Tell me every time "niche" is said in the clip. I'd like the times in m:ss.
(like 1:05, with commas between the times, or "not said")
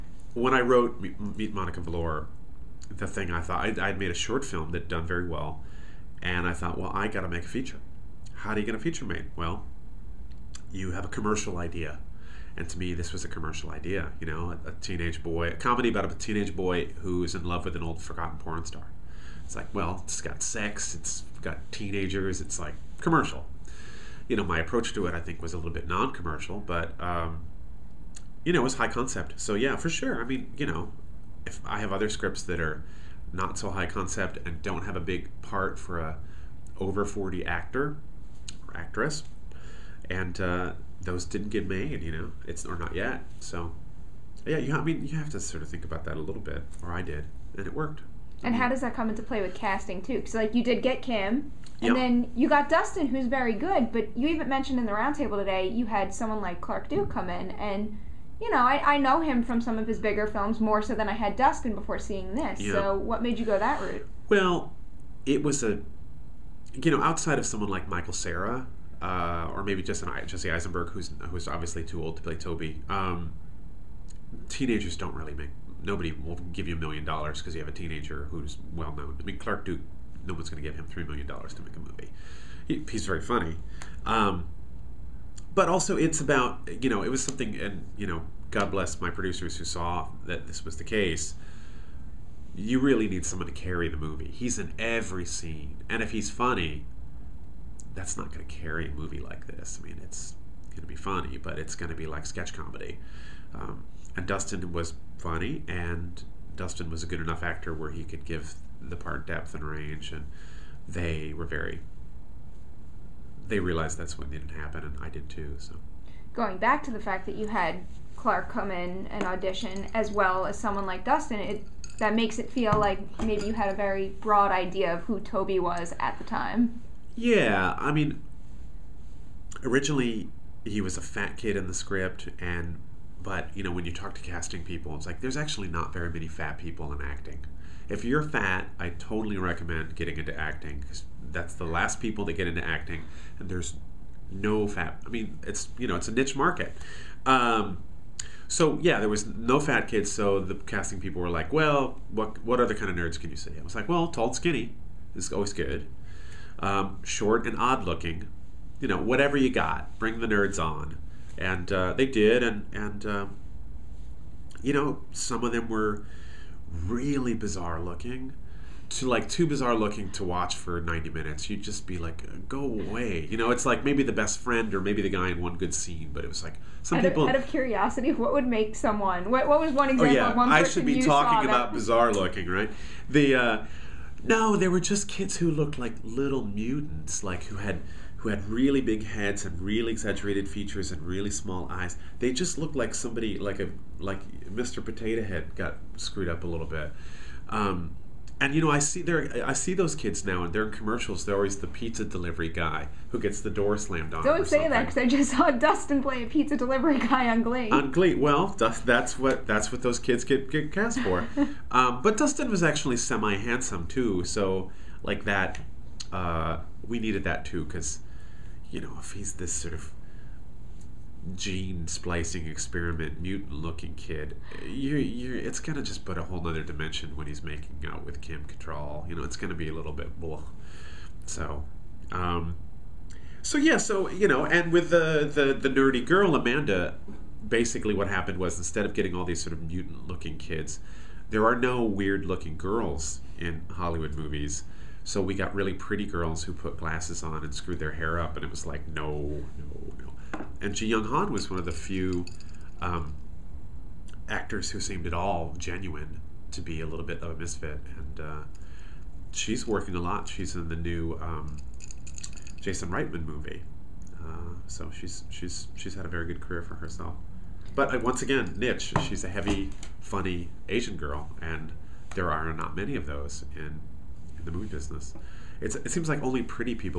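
2:26, 4:28.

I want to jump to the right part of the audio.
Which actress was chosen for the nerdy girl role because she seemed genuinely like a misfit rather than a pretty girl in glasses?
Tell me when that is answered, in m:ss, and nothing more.
4:10.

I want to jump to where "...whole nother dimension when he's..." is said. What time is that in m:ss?
3:46.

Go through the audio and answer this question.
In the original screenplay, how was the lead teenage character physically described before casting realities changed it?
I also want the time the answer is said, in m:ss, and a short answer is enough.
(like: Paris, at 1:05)
A fat kid, at 2:10.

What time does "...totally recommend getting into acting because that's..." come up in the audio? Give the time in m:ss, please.
2:18.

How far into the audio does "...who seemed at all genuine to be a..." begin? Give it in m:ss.
4:14.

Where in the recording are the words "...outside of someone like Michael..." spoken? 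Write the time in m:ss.
1:07.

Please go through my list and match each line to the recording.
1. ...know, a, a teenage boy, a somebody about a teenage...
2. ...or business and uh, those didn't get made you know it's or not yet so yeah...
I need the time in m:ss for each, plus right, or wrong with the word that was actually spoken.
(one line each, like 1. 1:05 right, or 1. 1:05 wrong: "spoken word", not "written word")
1. 0:14 wrong: "comedy", not "somebody"
2. 0:38 wrong: "actress", not "business".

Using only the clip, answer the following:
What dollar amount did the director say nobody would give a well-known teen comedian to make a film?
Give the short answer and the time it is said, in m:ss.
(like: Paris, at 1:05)
3 million dollars, at 1:20.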